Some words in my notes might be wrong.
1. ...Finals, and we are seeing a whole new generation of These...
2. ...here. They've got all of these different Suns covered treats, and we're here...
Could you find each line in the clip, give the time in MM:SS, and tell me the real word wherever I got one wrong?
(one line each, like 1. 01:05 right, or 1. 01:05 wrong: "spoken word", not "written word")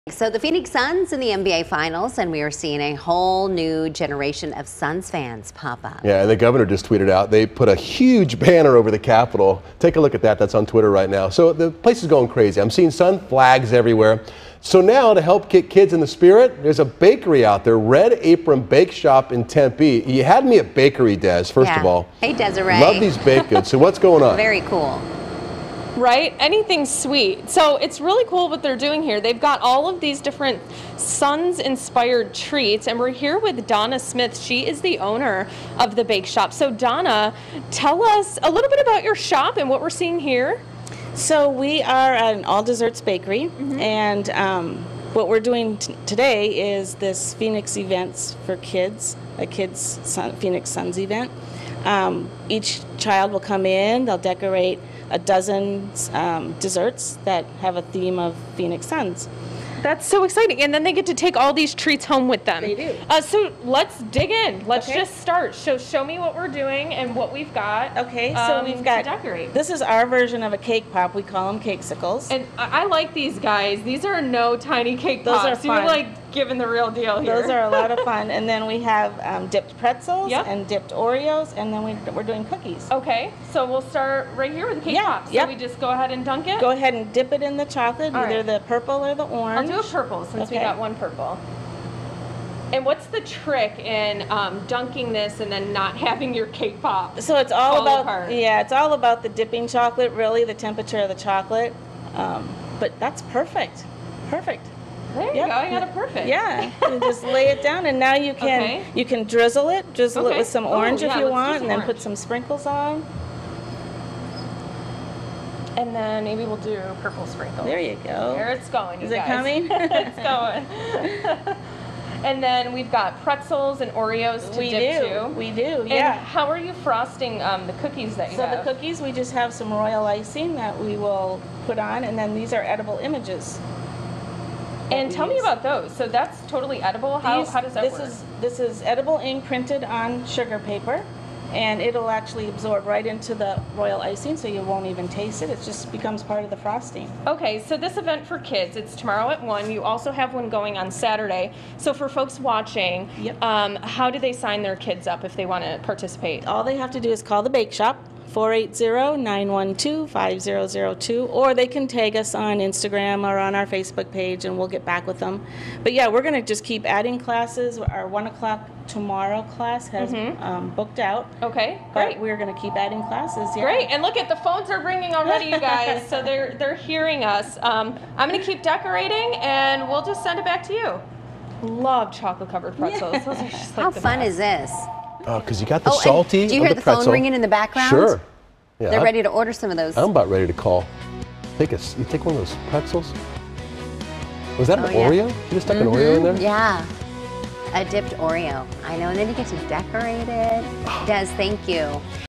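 1. 00:01 wrong: "Suns", not "These"
2. 00:29 wrong: "inspired", not "covered".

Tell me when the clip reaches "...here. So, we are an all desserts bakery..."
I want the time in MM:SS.
00:40.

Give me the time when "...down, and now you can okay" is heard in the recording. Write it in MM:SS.
01:47.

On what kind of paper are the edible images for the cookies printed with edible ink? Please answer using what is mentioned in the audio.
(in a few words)
sugar paper.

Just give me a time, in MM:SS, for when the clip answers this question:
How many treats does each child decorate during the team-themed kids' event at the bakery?
00:55.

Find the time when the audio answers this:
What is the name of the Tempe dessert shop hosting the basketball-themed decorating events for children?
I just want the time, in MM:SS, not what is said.
00:17.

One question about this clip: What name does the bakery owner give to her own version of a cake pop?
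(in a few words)
cakesicles.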